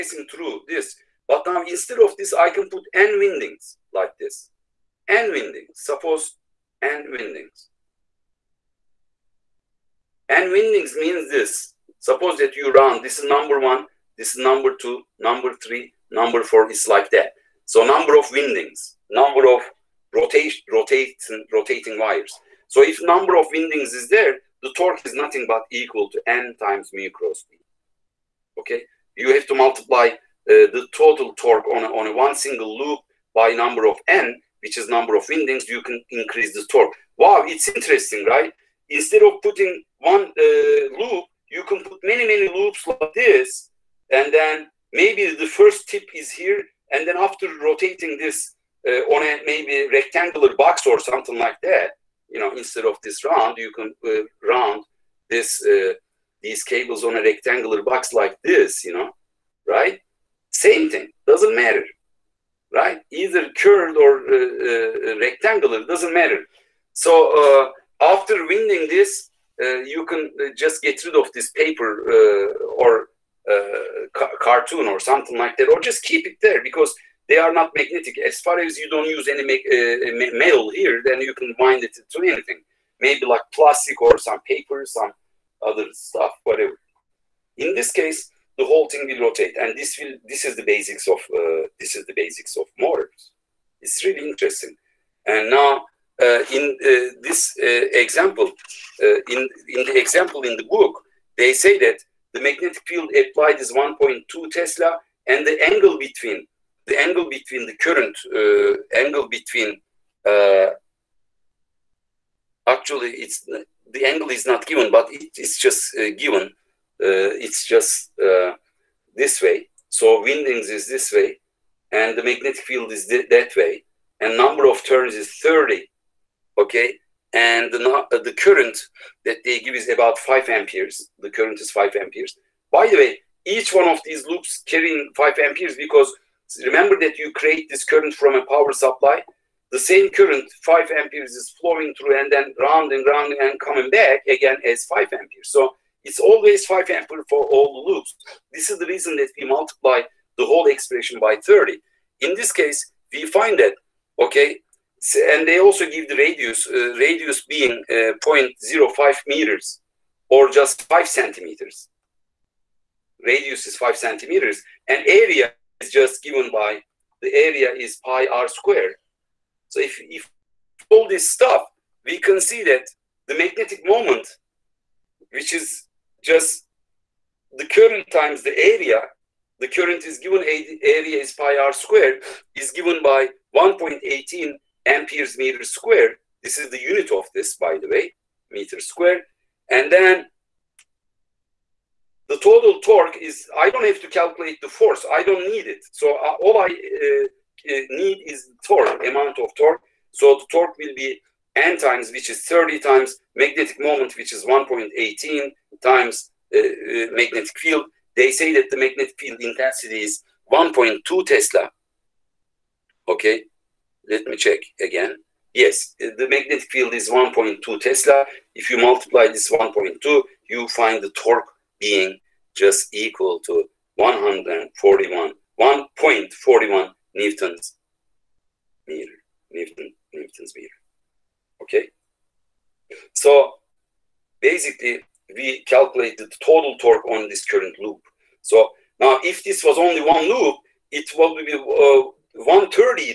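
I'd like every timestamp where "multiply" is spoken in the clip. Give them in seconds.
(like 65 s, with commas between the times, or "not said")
29 s, 149 s, 218 s.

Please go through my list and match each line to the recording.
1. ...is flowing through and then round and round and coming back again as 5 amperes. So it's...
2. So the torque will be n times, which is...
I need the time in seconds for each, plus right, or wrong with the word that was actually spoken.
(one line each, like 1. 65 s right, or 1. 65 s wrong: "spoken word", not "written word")
1. 141 s right
2. 200 s right.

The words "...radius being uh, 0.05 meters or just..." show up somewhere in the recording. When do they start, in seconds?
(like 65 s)
156 s.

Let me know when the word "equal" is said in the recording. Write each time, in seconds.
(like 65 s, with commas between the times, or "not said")
25 s, 222 s.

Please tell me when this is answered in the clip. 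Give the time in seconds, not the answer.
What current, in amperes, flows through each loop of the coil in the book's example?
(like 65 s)
129 s.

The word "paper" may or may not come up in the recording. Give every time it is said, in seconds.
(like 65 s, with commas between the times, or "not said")
71 s, 84 s.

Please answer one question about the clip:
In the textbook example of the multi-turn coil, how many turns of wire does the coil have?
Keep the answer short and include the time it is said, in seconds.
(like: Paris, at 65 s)
30, at 124 s.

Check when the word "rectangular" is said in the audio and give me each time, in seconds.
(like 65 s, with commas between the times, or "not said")
49 s, 57 s, 65 s.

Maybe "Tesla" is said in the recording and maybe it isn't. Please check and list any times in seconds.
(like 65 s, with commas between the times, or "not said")
104 s, 211 s, 217 s.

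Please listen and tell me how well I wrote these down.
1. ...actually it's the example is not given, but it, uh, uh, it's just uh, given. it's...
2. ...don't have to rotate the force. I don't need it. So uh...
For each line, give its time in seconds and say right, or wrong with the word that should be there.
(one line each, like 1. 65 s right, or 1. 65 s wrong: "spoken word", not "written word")
1. 112 s wrong: "angle", not "example"
2. 193 s wrong: "calculate", not "rotate".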